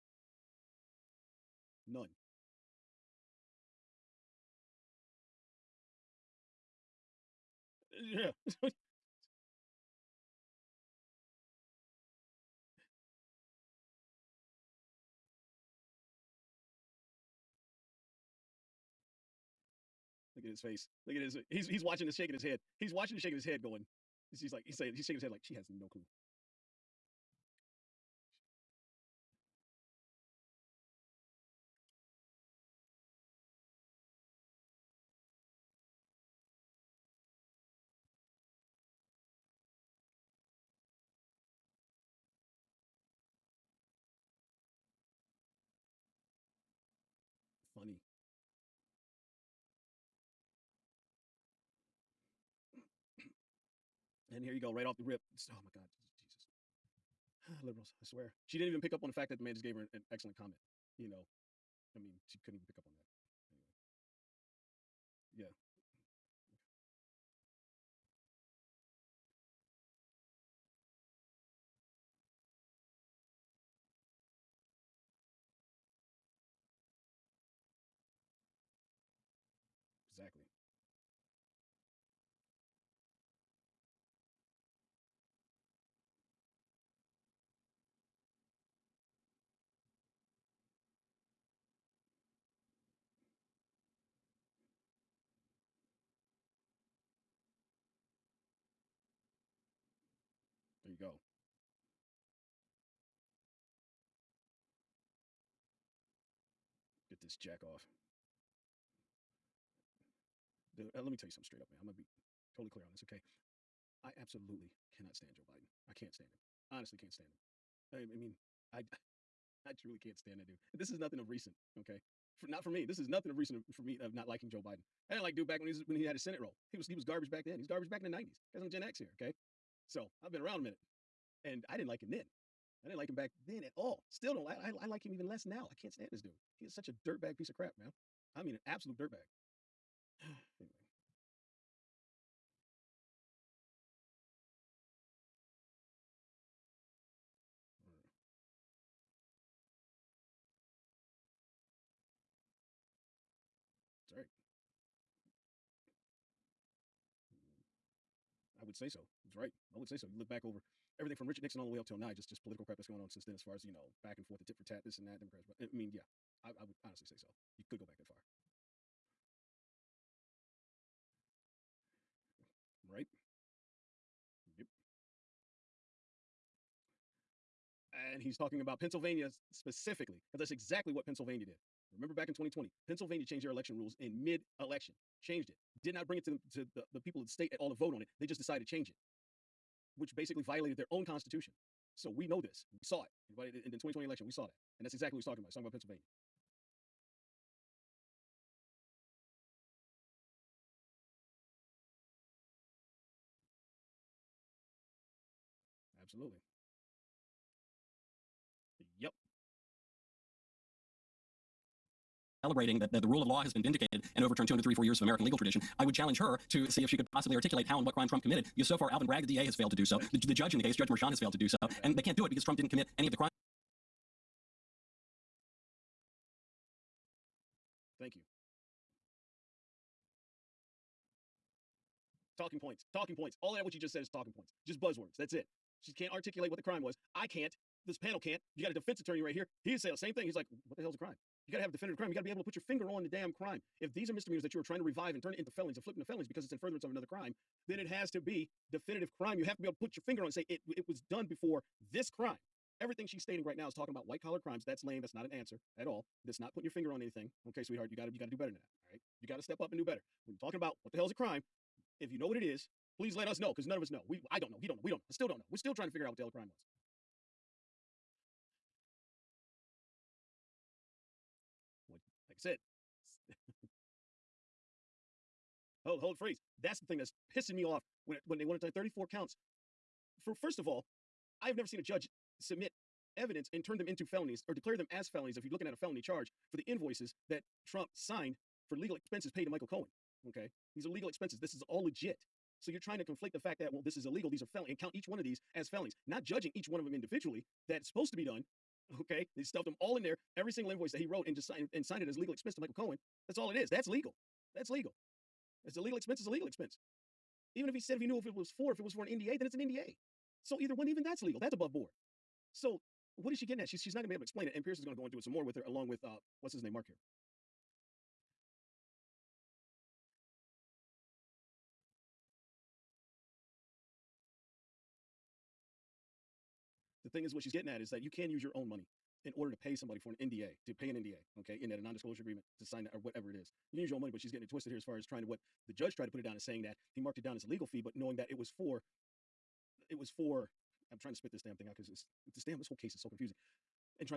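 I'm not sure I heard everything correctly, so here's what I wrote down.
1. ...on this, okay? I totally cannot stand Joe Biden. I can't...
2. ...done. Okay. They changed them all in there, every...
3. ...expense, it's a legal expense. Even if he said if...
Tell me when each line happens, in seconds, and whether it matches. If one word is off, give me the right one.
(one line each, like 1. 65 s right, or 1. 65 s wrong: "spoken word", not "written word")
1. 112 s wrong: "absolutely", not "totally"
2. 298 s wrong: "stuffed", not "changed"
3. 305 s right.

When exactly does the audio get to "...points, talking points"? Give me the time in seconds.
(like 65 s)
232 s.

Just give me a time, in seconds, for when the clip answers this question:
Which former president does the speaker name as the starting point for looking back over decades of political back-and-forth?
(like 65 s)
161 s.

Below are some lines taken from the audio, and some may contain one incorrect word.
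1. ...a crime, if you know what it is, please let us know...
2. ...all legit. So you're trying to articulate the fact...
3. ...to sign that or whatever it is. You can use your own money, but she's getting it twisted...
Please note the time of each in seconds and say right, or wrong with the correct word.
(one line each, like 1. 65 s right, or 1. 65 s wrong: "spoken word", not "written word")
1. 261 s right
2. 291 s wrong: "conflate", not "articulate"
3. 332 s right.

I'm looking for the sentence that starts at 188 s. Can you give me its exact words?
They just decided to change it, which basically violated their own constitution.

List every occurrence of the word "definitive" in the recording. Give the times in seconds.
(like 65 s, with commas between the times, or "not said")
241 s, 248 s.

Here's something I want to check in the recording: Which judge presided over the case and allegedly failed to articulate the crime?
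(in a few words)
Judge Merchan.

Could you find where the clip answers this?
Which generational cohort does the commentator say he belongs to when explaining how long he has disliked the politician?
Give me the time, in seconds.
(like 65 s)
128 s.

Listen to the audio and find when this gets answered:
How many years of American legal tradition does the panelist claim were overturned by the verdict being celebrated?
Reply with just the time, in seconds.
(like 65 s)
214 s.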